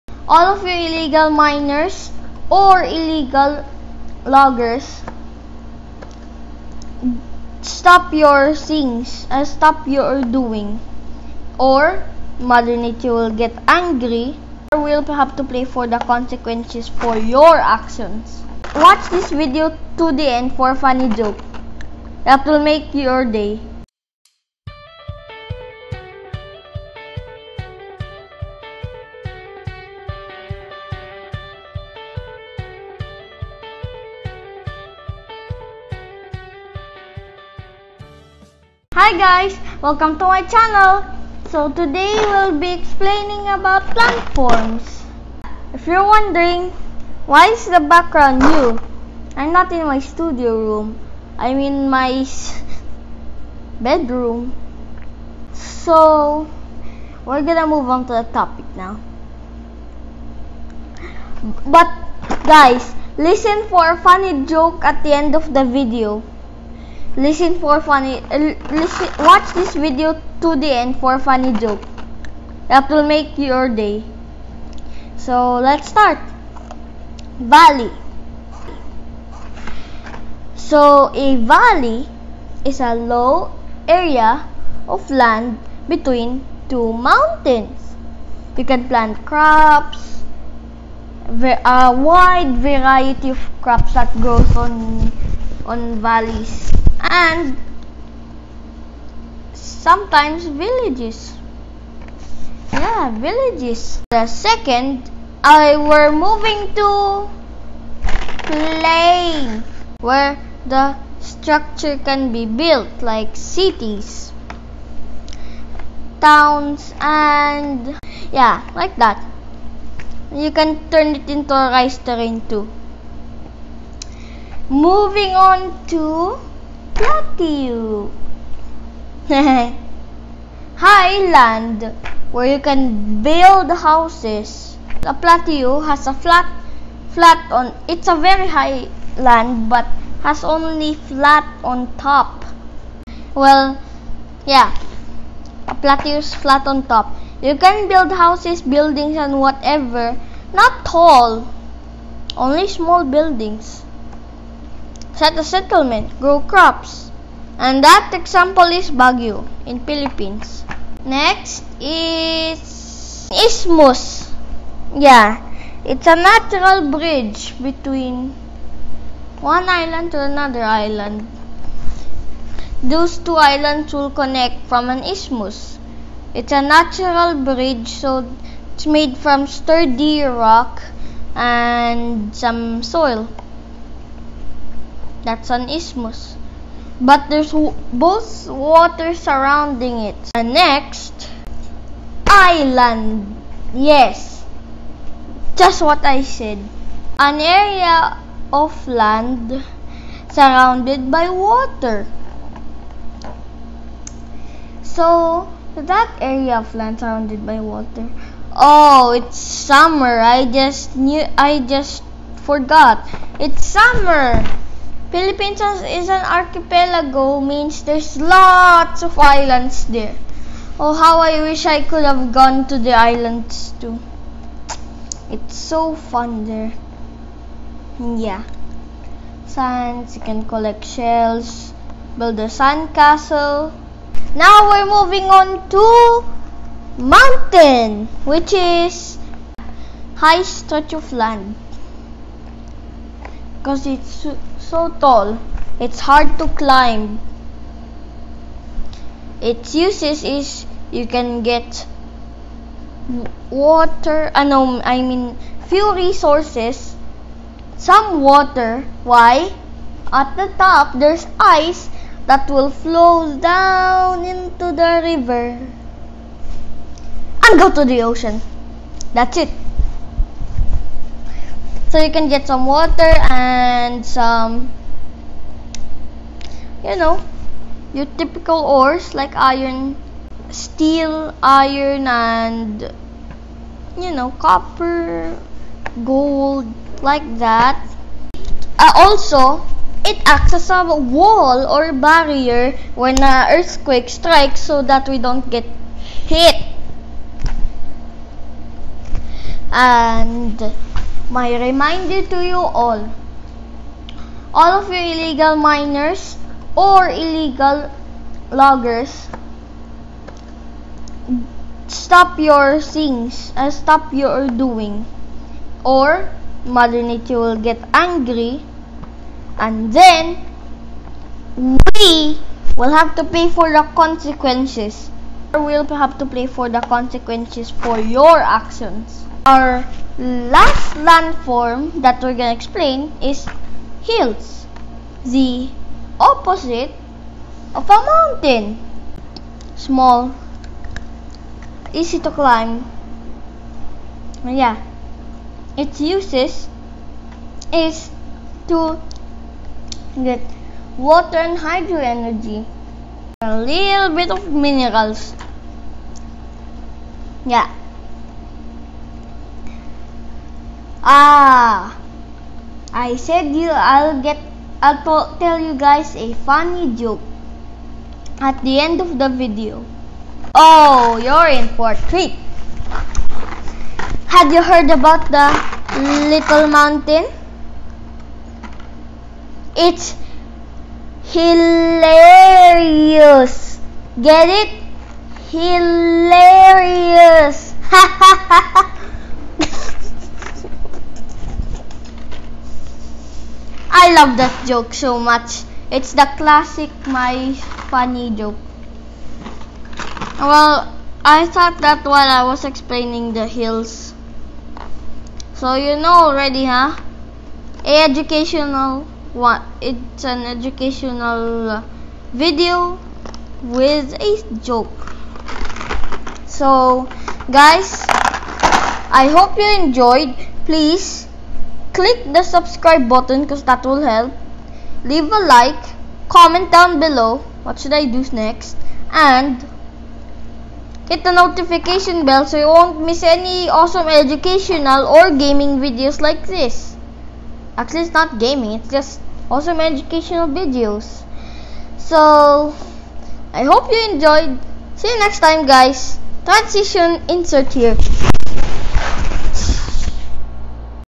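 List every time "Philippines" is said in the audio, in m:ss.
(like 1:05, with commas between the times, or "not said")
2:39, 3:35.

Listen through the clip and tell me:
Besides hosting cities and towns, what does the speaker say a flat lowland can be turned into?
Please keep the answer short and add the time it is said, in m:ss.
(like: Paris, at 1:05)
rice terrain, at 2:01.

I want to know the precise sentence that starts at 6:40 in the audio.
Well, I thought that while I was explaining the hills.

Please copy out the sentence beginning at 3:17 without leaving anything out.
An area of land surrounded by water.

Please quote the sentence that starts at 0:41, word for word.
So today we'll be explaining about plant forms.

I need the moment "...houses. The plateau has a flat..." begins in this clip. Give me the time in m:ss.
2:13.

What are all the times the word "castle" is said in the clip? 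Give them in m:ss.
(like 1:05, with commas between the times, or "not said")
3:52.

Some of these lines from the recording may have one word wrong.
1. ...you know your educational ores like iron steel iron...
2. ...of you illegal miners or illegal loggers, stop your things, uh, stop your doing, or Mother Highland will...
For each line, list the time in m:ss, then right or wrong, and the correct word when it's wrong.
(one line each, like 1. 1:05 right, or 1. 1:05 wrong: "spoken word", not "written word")
1. 4:36 wrong: "typical", not "educational"
2. 5:04 wrong: "Nature", not "Highland".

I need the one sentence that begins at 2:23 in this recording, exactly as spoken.
Well, yeah, a plateau is flat on top.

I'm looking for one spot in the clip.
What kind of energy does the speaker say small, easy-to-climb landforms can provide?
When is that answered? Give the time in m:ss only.
5:51.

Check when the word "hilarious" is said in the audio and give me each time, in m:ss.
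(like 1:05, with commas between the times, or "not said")
6:21, 6:25.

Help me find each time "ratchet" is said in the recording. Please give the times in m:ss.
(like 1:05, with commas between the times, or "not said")
not said.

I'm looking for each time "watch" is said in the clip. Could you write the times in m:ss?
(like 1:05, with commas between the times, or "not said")
0:18, 1:09.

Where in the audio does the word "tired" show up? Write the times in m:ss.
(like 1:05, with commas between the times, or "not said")
not said.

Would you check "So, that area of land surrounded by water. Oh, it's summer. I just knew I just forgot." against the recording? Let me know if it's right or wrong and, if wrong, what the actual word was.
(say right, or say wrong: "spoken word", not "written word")
right.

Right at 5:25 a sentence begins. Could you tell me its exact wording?
Or we'll have to pay for the consequences for your actions.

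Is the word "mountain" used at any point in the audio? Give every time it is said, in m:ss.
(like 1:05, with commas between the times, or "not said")
1:26, 3:57, 5:38, 6:16.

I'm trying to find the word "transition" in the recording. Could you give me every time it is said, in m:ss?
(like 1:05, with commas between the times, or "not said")
7:26.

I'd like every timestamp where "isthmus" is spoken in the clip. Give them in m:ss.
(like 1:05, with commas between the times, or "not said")
2:43, 2:55, 3:05.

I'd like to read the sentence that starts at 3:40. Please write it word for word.
Oh, how I wish I could have gone to the islands too.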